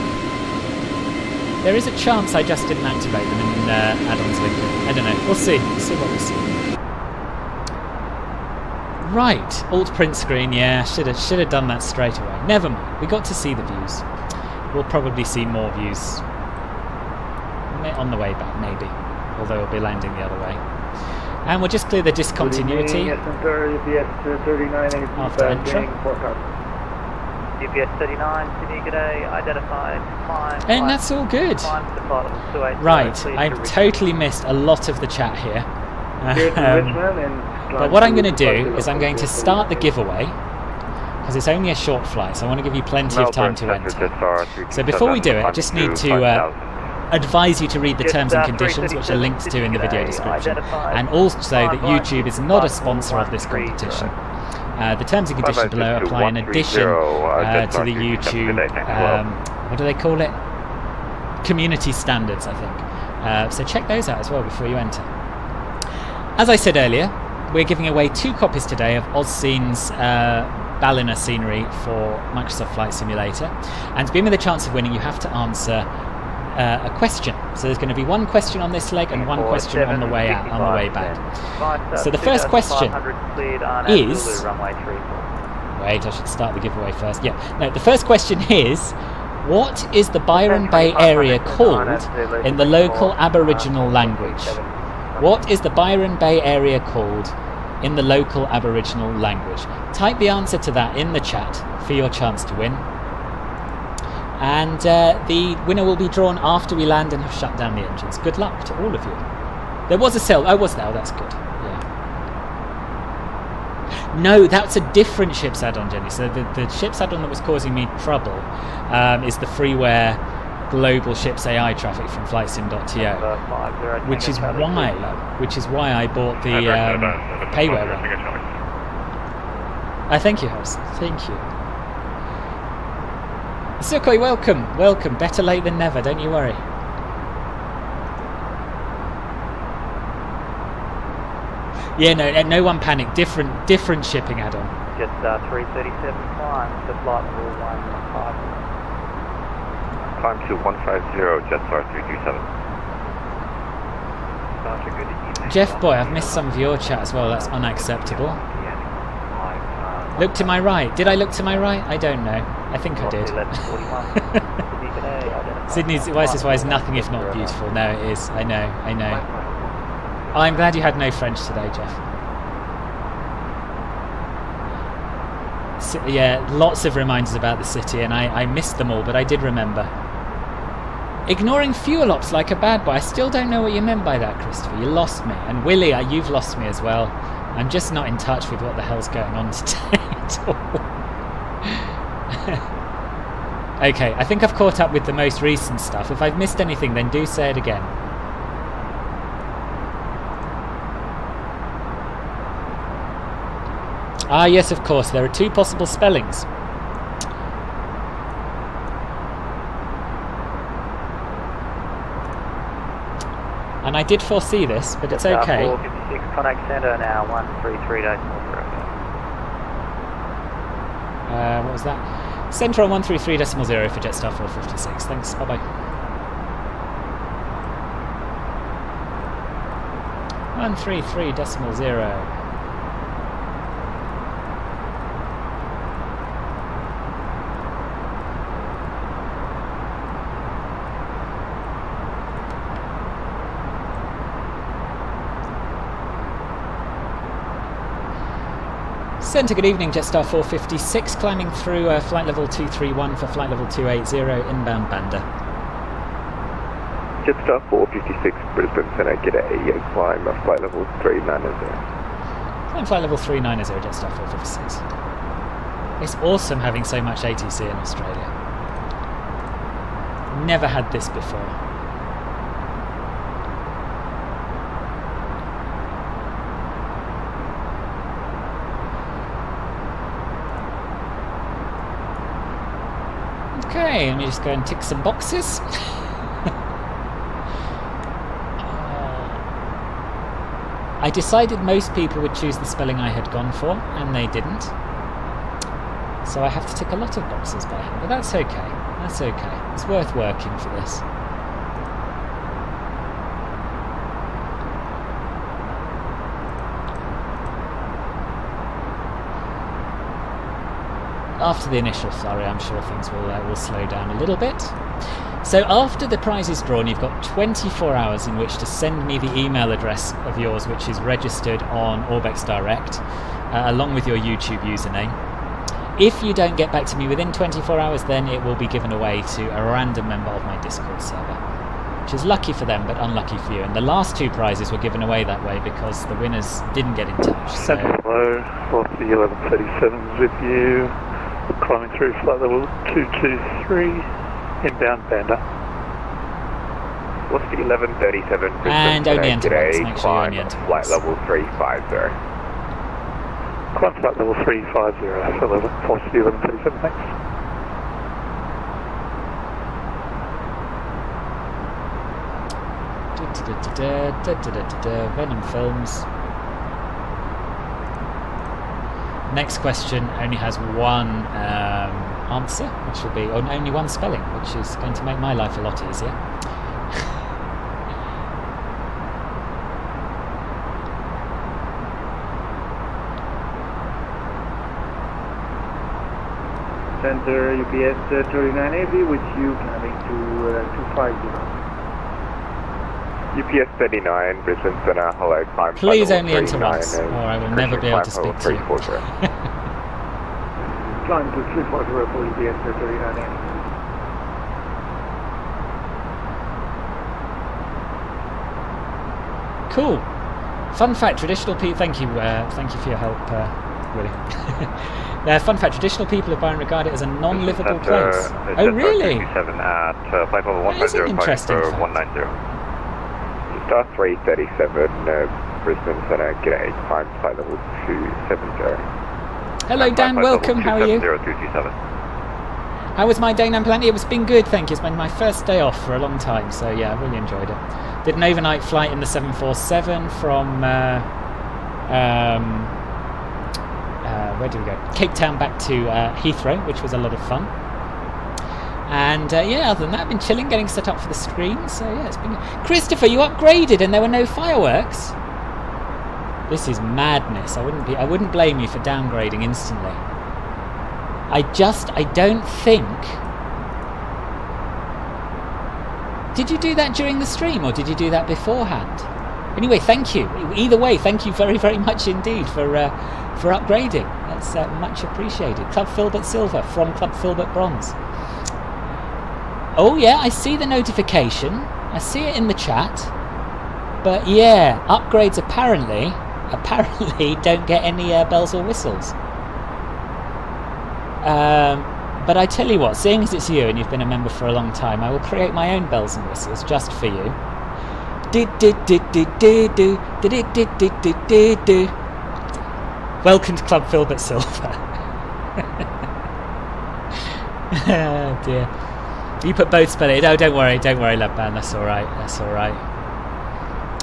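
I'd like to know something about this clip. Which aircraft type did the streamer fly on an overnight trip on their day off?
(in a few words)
747.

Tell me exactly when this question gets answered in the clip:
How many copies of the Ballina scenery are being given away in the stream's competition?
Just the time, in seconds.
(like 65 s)
68 s.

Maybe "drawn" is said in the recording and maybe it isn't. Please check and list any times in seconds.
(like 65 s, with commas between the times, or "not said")
106 s, 316 s.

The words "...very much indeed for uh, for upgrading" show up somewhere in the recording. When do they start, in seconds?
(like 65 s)
471 s.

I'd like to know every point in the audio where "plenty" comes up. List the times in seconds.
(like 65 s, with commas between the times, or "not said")
42 s, 433 s.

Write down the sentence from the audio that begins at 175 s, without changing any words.
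So, yeah, lots of reminders about the city, and I, I missed them all, but I did remember.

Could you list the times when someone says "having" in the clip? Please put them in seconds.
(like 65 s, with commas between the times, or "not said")
266 s.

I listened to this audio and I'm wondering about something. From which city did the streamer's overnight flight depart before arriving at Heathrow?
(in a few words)
Cape Town.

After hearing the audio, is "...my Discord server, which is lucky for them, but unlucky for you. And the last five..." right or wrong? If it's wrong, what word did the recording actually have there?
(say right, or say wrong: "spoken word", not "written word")
wrong: "two", not "five".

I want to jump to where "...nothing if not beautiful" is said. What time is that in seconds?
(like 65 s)
166 s.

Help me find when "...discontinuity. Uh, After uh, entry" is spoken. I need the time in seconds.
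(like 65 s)
22 s.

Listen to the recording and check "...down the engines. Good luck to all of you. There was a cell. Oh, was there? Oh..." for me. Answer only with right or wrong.
right.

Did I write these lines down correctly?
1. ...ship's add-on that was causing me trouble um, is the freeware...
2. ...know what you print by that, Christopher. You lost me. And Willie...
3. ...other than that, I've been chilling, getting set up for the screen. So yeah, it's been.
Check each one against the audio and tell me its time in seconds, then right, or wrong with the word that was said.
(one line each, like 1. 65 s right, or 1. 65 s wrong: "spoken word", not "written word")
1. 116 s right
2. 183 s wrong: "meant", not "print"
3. 449 s right.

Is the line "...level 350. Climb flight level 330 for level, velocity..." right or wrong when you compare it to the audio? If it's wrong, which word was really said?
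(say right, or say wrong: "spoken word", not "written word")
wrong: "350", not "330".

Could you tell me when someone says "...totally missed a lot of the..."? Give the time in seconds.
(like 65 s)
33 s.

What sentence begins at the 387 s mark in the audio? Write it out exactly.
Center UPS uh, thirty nine 3980, which you can make to uh, 250.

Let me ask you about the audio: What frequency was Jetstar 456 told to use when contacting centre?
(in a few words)
133.40.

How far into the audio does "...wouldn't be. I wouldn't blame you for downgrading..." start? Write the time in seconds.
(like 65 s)
457 s.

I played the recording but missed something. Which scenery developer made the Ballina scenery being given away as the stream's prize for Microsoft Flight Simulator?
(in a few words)
AUScene.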